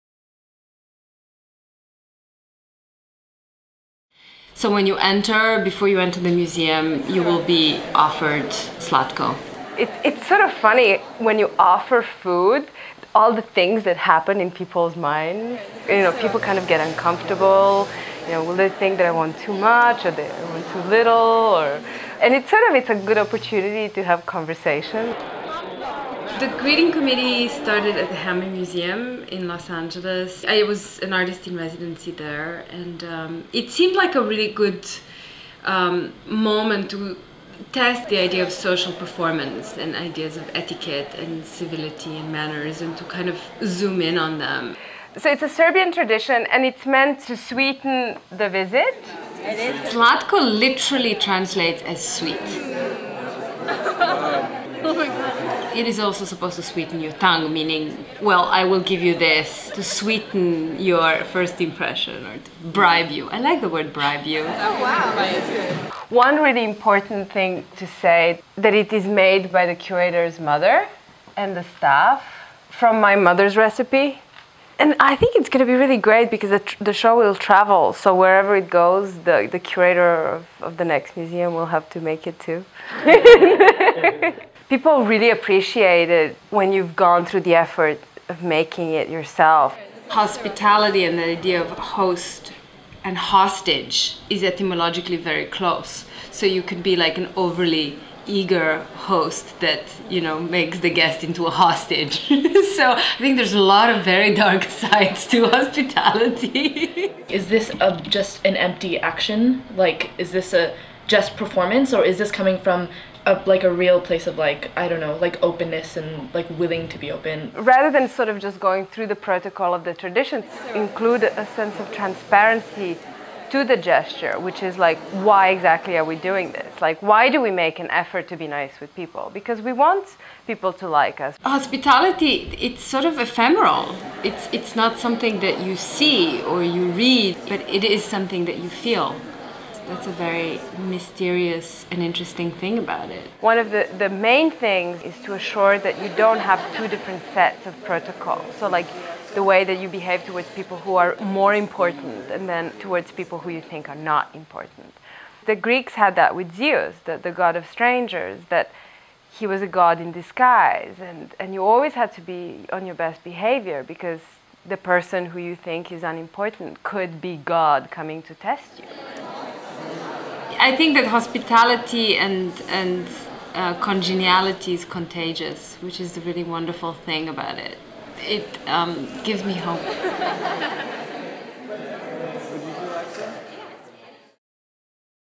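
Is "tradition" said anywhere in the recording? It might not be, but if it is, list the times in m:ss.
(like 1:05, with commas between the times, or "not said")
0:45, 1:59.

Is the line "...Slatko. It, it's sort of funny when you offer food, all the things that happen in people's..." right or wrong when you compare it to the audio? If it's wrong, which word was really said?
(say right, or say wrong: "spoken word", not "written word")
right.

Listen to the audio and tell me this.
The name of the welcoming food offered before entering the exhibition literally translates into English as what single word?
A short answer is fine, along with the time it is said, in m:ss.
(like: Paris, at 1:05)
sweet, at 0:52.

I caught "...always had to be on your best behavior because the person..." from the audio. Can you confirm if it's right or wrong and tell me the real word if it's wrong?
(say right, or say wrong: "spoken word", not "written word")
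right.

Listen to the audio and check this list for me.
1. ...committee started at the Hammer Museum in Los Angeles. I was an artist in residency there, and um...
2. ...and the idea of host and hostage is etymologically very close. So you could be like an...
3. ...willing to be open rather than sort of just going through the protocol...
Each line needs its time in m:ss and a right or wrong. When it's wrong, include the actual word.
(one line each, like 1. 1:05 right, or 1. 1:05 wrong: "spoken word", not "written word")
1. 0:26 right
2. 1:31 right
3. 1:56 right.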